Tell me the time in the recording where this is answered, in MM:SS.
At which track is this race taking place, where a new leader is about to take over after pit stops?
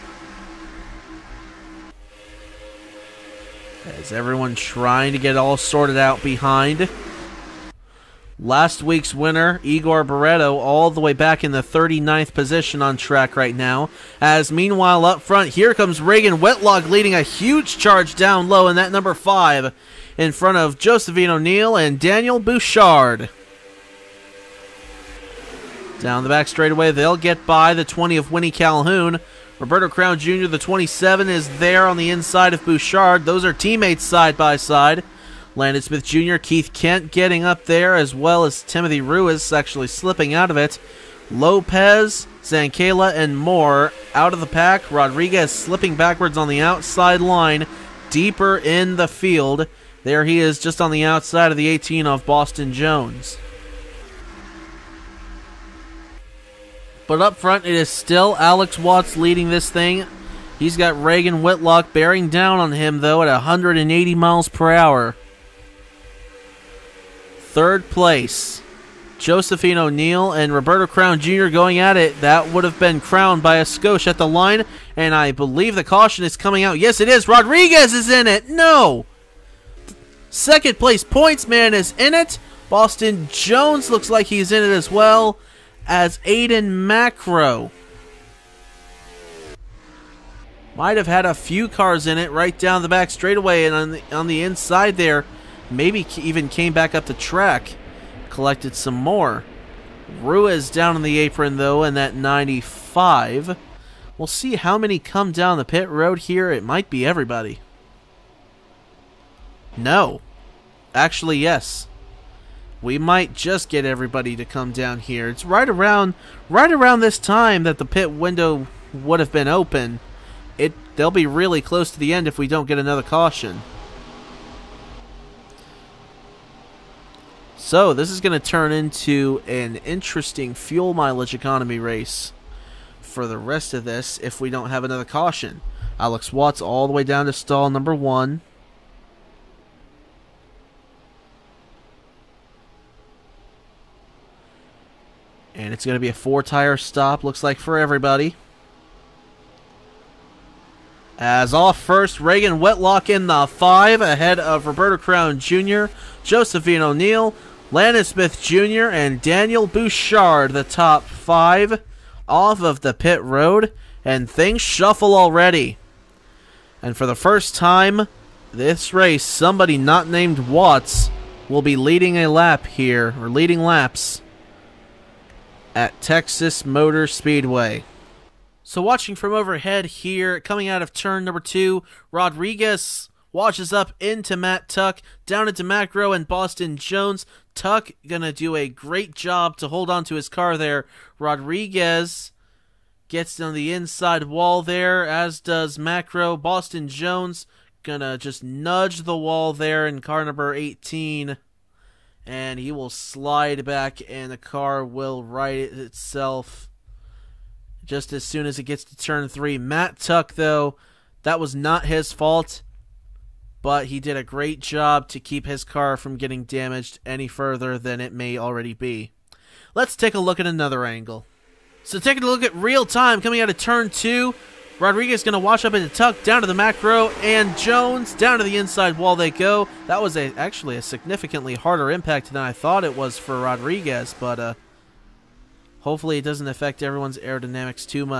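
02:56.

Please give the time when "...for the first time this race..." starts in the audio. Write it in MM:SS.
02:46.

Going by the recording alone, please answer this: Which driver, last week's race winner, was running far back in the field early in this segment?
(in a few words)
Igor Barreto.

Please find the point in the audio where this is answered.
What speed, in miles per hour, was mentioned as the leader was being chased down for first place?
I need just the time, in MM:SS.
01:03.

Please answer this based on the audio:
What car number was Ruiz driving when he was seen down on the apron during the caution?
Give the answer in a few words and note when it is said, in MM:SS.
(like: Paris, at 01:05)
95, at 01:42.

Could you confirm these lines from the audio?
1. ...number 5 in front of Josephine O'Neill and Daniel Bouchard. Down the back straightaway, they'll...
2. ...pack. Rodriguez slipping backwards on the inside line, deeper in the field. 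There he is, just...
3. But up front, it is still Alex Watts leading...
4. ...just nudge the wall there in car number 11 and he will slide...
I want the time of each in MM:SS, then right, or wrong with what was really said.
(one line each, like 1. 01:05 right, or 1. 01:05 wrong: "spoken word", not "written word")
1. 00:18 right
2. 00:44 wrong: "outside", not "inside"
3. 00:57 right
4. 03:18 wrong: "18", not "11".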